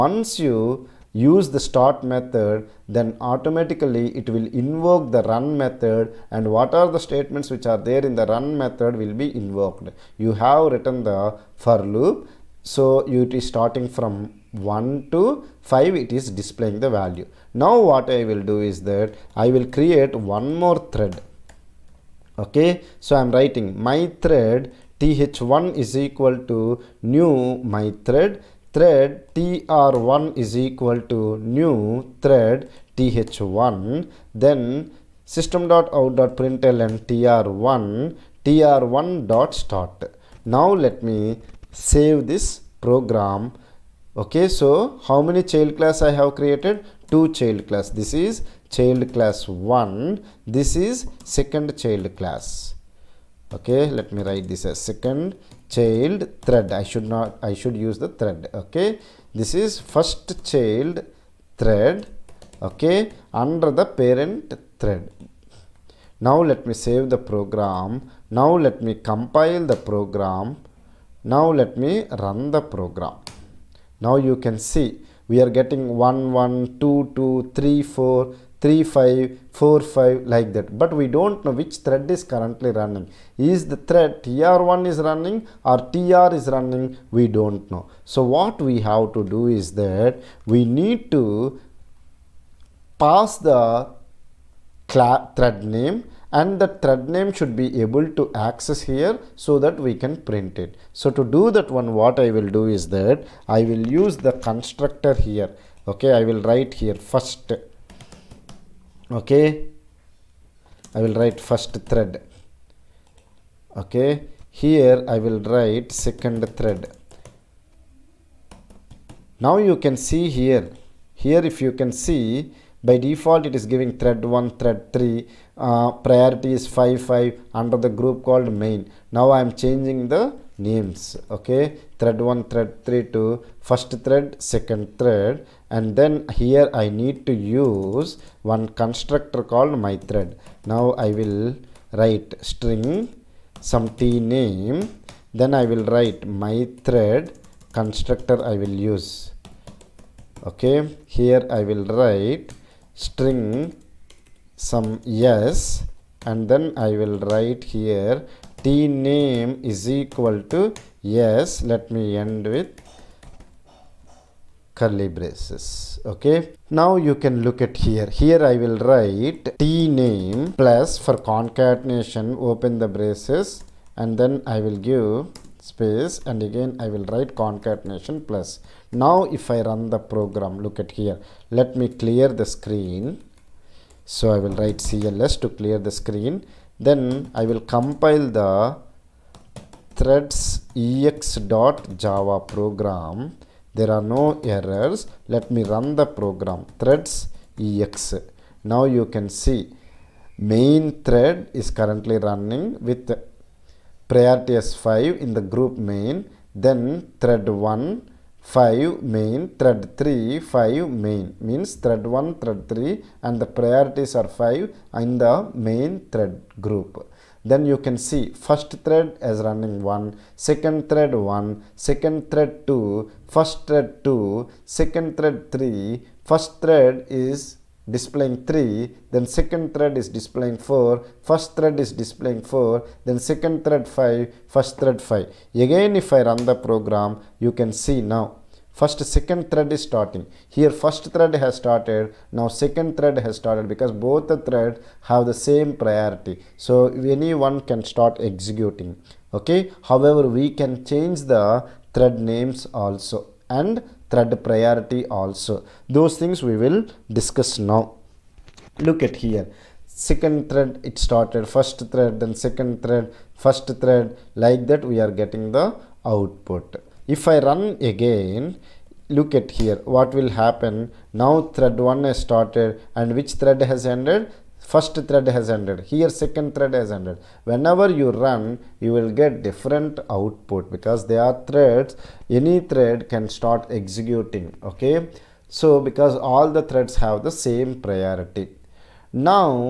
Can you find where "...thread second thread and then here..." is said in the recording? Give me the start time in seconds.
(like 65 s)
134 s.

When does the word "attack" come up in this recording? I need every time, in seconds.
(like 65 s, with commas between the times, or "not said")
not said.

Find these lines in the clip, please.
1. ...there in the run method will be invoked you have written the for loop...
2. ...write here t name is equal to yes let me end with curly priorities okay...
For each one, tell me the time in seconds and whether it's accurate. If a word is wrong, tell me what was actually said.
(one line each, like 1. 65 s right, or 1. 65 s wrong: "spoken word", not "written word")
1. 7 s right
2. 157 s wrong: "braces", not "priorities".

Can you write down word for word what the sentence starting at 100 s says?
So to do that one what I will do is that I will use the constructor here.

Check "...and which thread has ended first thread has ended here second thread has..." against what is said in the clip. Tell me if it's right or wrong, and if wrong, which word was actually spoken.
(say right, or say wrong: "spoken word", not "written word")
right.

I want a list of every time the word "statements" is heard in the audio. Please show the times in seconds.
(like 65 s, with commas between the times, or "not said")
7 s.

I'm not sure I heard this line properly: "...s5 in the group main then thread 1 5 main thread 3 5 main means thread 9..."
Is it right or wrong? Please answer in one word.
wrong.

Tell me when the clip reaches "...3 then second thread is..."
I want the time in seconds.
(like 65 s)
228 s.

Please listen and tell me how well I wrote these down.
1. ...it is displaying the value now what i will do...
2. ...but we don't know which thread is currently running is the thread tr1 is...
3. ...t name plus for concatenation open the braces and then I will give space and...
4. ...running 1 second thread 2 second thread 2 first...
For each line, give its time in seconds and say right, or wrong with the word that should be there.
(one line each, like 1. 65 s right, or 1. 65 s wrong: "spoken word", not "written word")
1. 15 s right
2. 80 s right
3. 169 s right
4. 219 s wrong: "1", not "2".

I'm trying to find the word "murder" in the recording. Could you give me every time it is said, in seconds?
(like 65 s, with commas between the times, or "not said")
not said.